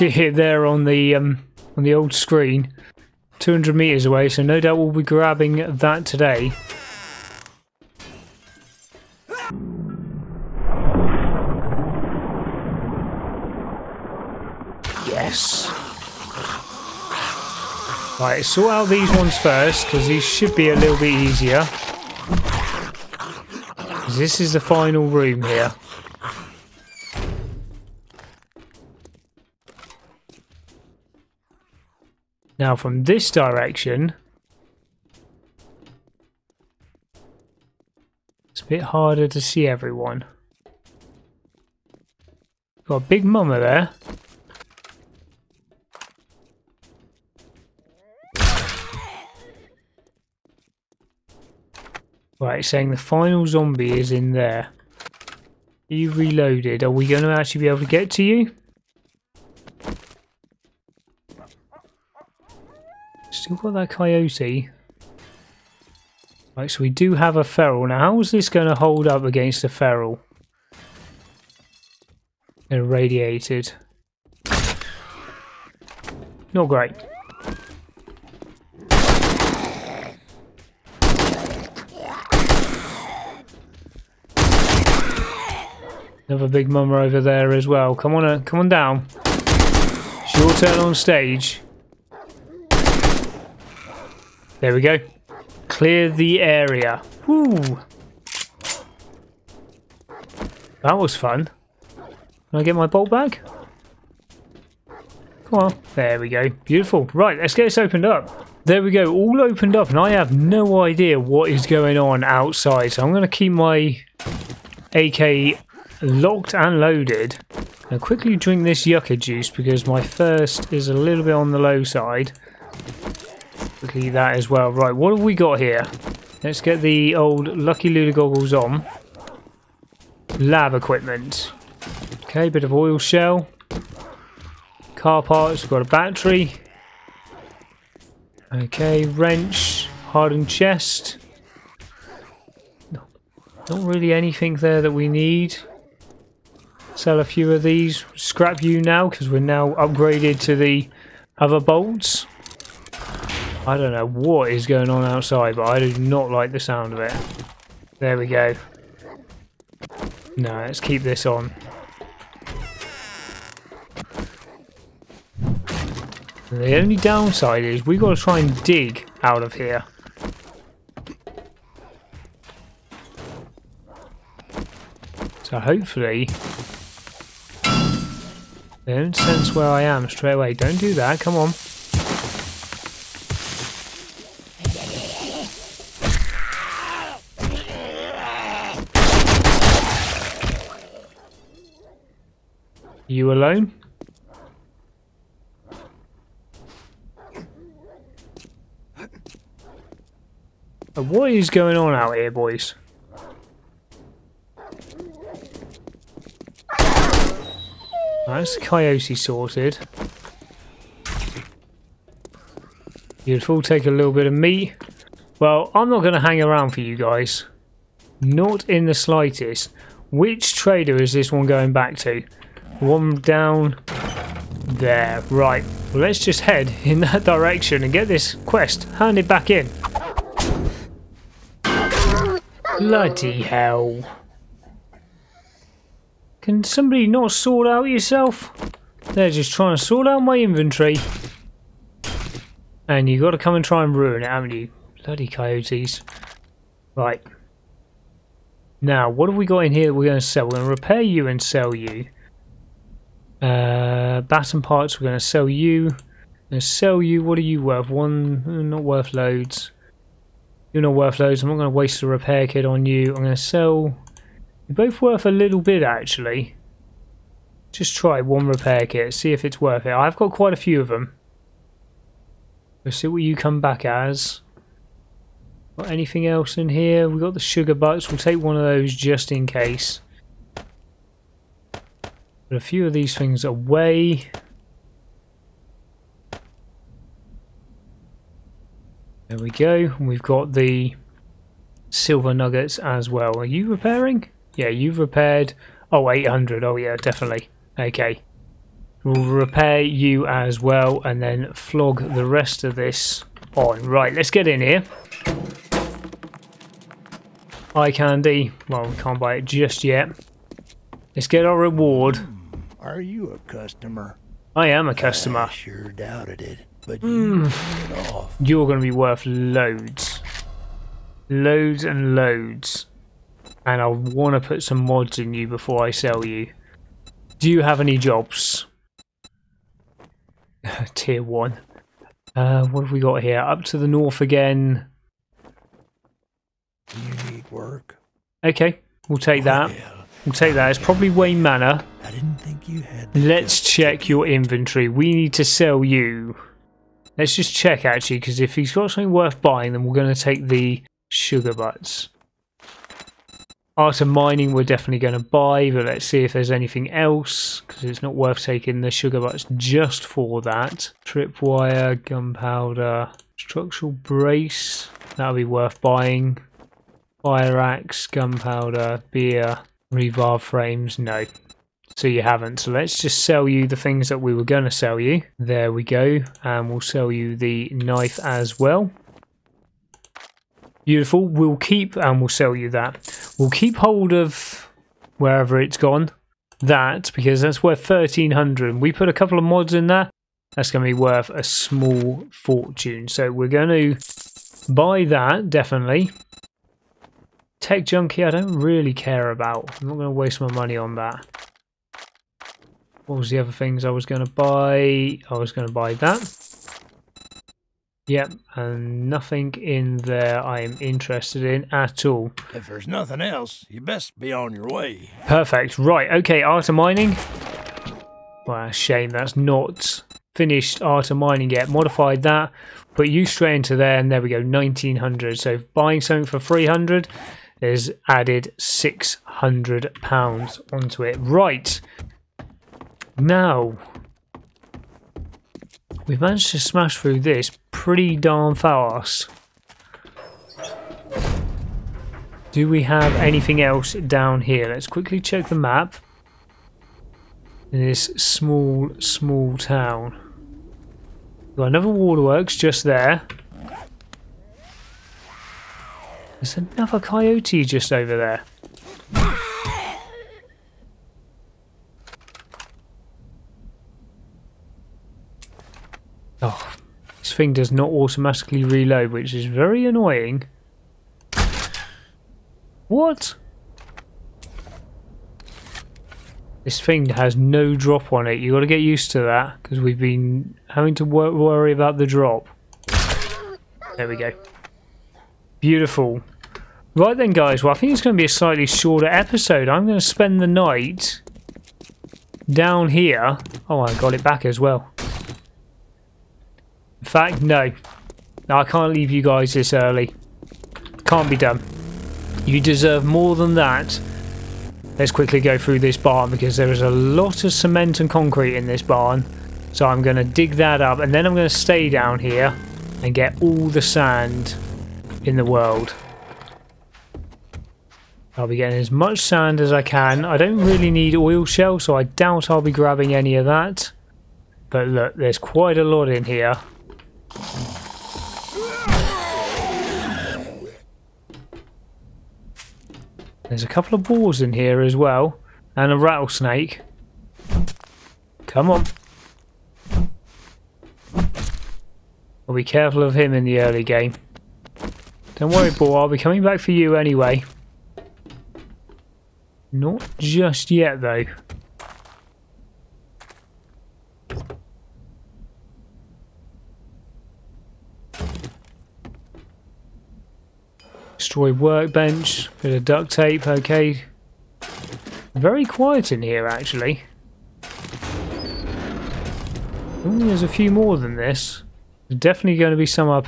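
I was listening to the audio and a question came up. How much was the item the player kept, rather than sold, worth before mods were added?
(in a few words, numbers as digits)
1300.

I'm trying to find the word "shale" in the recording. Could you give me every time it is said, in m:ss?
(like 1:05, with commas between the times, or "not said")
2:12, 8:41.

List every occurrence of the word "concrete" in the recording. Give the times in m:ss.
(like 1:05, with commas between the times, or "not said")
8:28.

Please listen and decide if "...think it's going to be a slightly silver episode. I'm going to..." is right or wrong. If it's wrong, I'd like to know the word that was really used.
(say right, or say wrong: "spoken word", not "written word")
wrong: "shorter", not "silver".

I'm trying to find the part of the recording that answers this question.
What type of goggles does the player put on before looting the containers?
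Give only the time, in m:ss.
2:07.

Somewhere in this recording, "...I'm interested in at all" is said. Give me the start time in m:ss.
6:50.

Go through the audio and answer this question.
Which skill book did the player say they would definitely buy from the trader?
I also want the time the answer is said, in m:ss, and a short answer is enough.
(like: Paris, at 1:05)
Art of Mining, at 5:53.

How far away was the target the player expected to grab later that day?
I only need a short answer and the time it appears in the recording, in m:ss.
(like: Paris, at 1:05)
200 meters, at 0:03.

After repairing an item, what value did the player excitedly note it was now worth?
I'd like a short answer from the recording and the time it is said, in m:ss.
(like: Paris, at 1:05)
800, at 4:56.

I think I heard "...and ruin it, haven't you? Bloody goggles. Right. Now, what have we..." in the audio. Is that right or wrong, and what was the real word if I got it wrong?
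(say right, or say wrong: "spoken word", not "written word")
wrong: "coyotes", not "goggles".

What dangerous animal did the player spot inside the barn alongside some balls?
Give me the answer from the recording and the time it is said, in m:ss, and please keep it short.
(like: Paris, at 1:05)
rattlesnake, at 8:55.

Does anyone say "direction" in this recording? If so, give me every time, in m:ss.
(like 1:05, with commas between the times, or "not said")
0:33, 3:47.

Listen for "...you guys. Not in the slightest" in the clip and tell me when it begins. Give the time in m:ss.
3:36.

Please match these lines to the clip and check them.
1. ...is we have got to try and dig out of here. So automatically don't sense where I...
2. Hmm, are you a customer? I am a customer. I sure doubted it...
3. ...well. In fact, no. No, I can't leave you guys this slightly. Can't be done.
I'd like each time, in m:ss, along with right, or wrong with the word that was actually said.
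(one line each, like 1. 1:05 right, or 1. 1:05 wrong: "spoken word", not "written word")
1. 2:47 wrong: "hopefully", not "automatically"
2. 5:12 right
3. 8:14 wrong: "early", not "slightly".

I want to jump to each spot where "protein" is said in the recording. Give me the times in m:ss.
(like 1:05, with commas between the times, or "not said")
not said.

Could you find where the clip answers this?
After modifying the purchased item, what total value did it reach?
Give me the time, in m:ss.
7:04.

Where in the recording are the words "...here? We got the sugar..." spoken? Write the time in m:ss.
4:36.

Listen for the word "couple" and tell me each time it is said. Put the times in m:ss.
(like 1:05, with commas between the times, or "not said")
6:29, 8:53.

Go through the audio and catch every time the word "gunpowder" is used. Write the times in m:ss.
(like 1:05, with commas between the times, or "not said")
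6:02, 6:08.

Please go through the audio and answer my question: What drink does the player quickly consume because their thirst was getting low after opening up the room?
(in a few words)
yucca juice.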